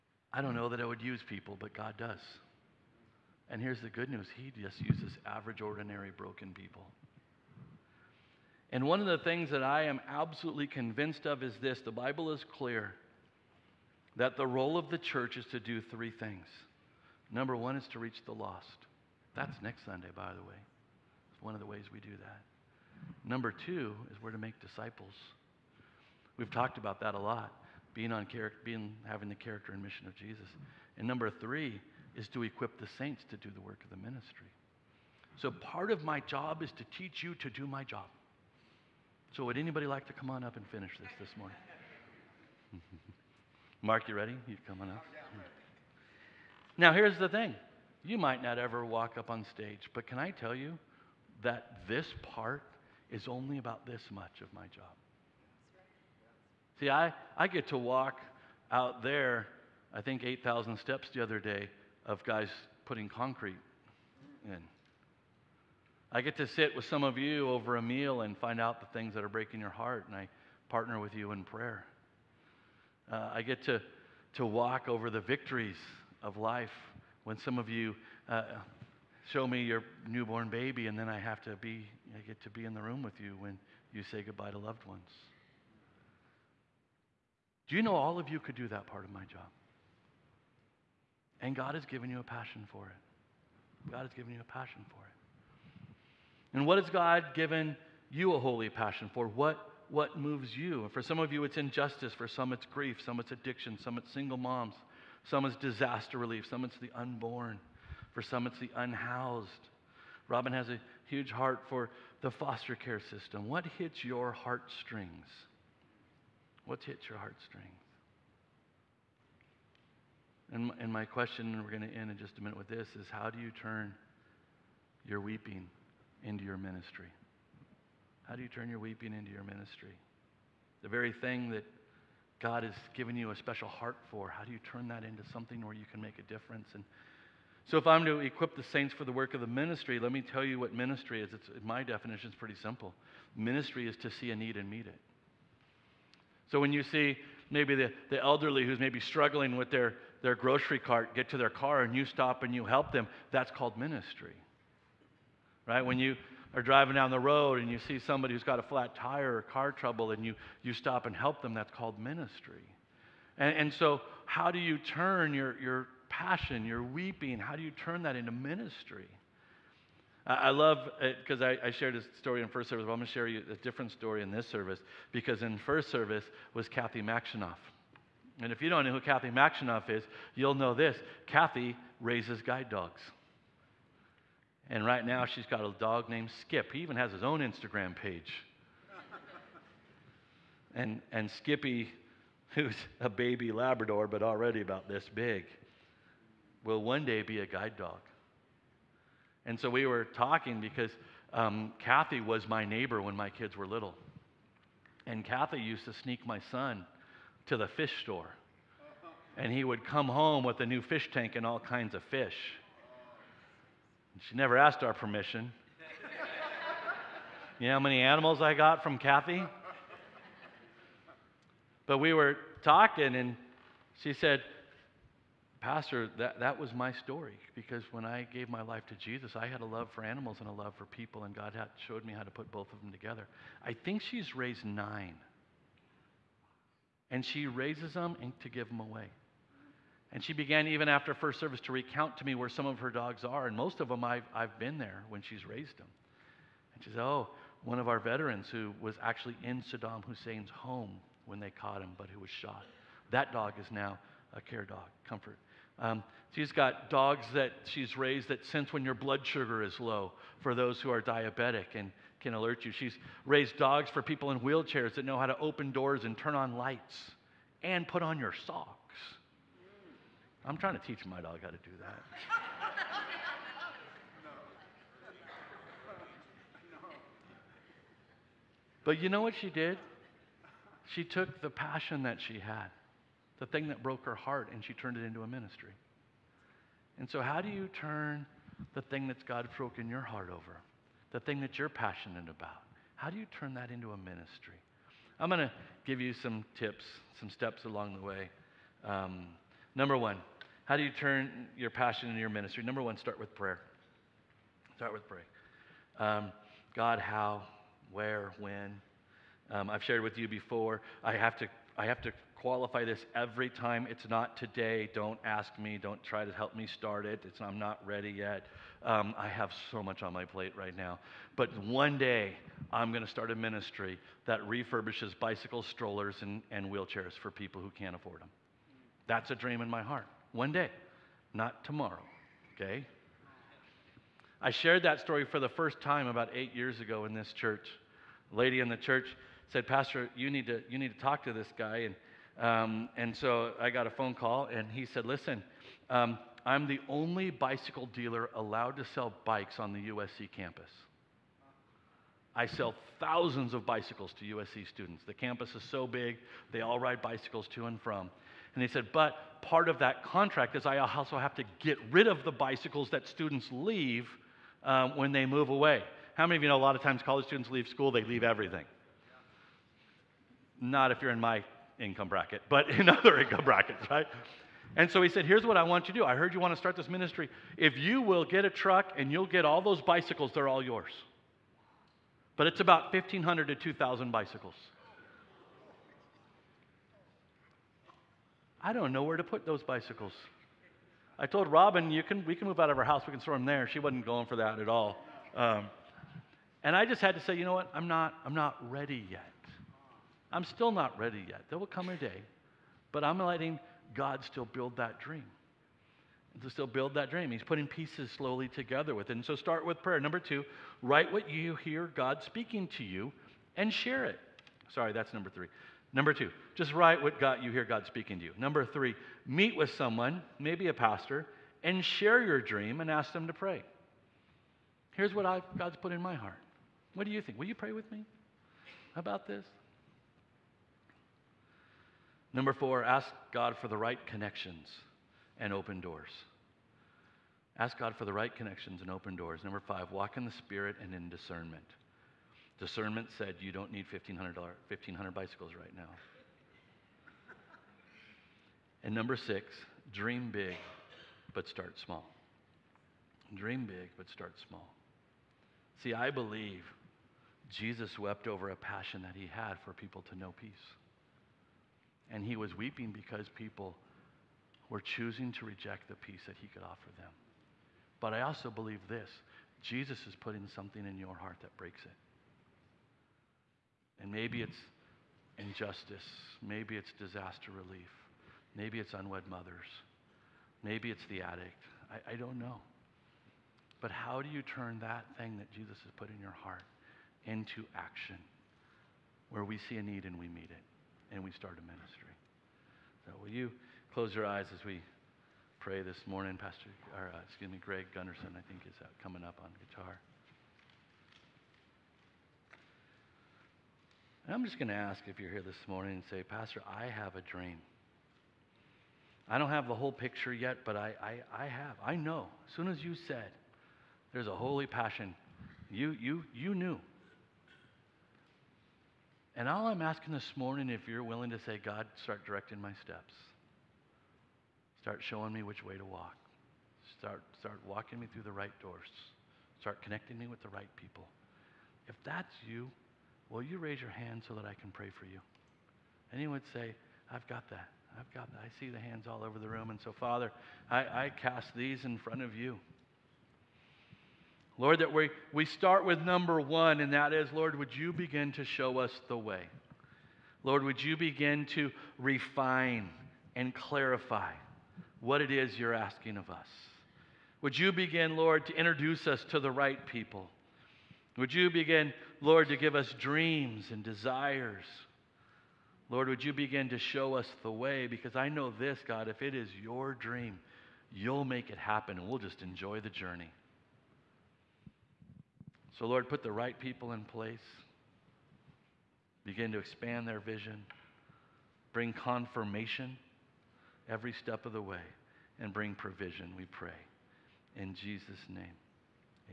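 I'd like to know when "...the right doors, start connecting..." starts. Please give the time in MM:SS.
08:48.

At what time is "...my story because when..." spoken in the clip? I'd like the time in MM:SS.
03:46.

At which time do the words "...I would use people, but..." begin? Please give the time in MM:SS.
00:00.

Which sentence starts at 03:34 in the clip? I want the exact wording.
And she never asked our permission.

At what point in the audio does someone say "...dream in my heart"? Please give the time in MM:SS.
05:29.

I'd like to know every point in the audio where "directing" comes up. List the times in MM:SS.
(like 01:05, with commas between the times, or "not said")
08:42.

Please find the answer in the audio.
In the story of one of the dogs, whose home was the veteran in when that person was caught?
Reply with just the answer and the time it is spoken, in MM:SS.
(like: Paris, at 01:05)
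Saddam Hussein, at 04:09.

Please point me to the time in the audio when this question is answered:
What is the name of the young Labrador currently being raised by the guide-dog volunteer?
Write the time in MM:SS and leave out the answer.
03:06.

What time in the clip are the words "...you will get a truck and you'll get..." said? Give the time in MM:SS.
06:17.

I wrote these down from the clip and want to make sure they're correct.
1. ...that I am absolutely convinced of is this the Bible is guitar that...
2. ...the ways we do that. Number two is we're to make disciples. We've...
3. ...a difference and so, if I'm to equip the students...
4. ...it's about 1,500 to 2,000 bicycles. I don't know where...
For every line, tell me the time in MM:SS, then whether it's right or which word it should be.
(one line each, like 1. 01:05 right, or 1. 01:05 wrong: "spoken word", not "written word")
1. 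00:09 wrong: "clear", not "guitar"
2. 00:21 right
3. 02:16 wrong: "saints", not "students"
4. 06:22 right.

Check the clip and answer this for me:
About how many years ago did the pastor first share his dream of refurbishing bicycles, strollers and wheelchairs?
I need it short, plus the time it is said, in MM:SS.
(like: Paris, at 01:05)
8, at 05:36.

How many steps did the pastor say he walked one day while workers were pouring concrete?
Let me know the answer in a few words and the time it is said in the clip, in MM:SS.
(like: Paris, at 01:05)
8,000, at 01:00.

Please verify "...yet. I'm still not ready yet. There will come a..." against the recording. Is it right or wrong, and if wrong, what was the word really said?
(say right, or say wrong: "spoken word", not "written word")
right.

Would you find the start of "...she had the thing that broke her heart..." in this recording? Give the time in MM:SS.
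04:42.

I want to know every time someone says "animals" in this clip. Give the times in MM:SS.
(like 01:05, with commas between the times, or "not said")
03:37, 03:50.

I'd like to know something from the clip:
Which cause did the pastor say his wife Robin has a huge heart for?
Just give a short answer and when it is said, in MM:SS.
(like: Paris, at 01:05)
foster care system, at 01:52.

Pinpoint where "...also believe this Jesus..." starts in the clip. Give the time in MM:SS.
07:48.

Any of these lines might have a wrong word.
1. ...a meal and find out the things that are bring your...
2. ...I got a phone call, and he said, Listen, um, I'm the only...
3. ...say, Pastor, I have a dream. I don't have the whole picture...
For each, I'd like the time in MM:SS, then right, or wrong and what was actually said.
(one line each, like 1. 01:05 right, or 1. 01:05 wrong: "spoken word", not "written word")
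1. 01:07 wrong: "breaking", not "bring"
2. 05:43 right
3. 08:26 right.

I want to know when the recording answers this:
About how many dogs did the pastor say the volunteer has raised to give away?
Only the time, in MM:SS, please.
03:54.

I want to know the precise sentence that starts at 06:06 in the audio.
How many of you know a lot of times college students leave school, they leave everything?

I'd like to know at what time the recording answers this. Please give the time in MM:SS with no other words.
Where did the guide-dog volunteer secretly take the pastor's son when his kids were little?
03:27.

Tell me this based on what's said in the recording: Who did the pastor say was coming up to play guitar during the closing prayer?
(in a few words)
Greg Gunderson.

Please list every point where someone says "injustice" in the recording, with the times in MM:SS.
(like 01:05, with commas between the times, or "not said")
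01:41, 07:55.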